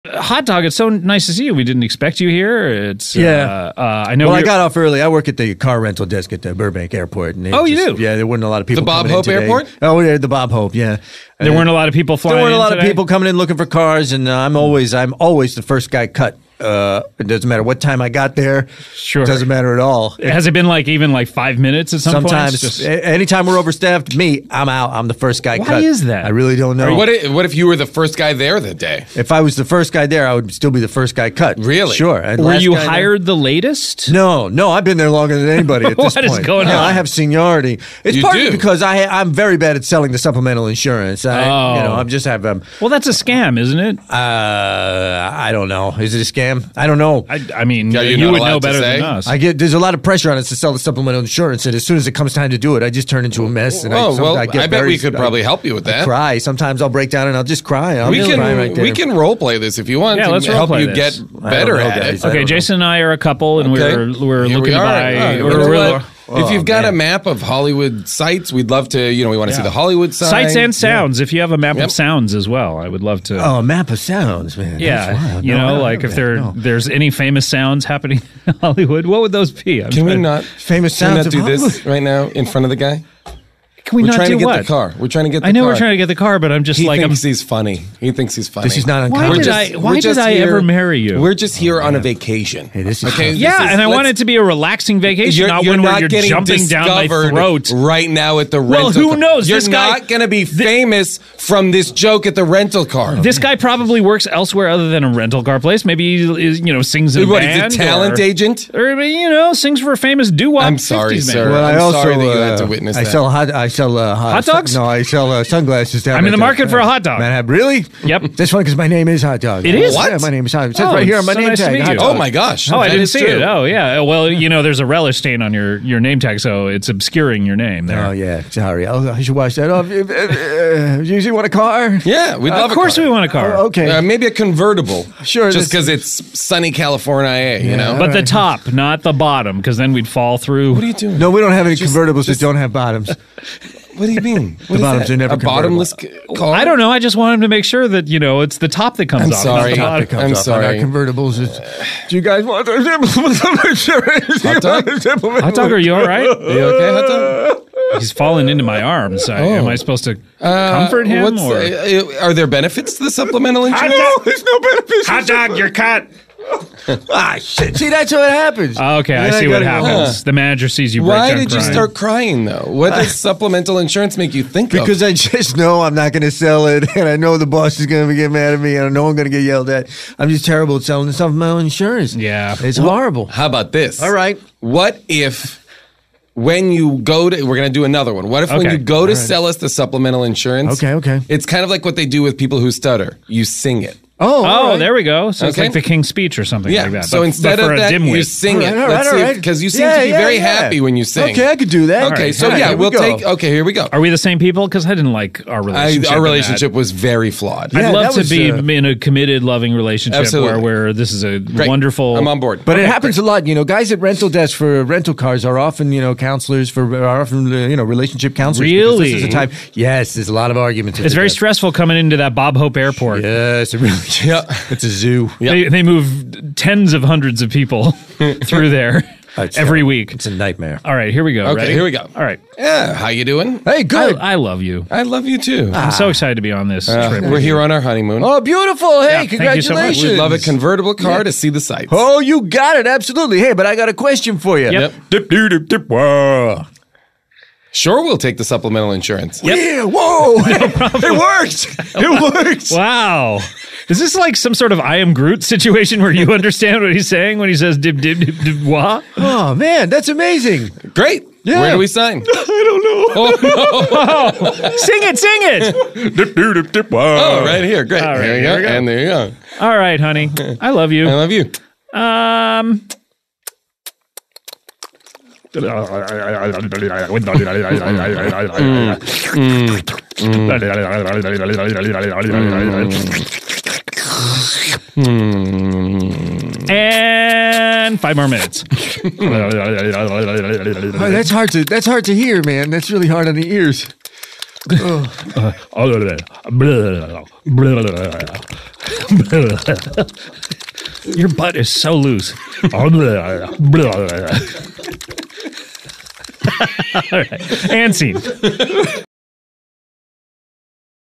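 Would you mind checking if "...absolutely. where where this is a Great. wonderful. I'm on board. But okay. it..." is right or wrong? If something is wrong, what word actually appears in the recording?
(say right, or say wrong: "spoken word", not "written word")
right.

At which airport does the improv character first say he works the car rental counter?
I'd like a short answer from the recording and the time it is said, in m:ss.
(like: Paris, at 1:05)
Burbank Airport, at 0:06.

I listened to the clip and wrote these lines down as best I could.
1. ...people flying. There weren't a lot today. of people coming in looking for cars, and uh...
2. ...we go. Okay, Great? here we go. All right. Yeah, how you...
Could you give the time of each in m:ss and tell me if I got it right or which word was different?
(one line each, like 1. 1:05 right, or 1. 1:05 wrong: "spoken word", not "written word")
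1. 0:11 right
2. 3:51 wrong: "Ready", not "Great".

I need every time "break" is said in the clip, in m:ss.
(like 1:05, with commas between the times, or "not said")
0:56, 2:51.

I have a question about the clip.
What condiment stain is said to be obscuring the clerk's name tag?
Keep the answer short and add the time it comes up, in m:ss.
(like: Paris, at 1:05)
relish, at 2:04.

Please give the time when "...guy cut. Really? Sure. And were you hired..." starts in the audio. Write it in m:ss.
0:31.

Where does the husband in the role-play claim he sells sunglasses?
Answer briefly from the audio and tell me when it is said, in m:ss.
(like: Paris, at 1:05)
Manhattan, at 1:57.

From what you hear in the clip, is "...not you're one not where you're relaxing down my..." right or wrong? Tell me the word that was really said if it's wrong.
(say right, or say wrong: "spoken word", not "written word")
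wrong: "jumping", not "relaxing".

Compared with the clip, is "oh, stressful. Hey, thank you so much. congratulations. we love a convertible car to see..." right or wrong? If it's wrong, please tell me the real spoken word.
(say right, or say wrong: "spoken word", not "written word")
wrong: "beautiful", not "stressful".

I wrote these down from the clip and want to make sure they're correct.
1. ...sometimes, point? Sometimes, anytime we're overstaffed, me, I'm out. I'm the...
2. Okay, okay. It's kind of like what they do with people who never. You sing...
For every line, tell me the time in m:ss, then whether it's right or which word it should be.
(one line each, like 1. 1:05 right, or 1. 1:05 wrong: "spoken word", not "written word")
1. 0:22 right
2. 3:10 wrong: "stutter", not "never".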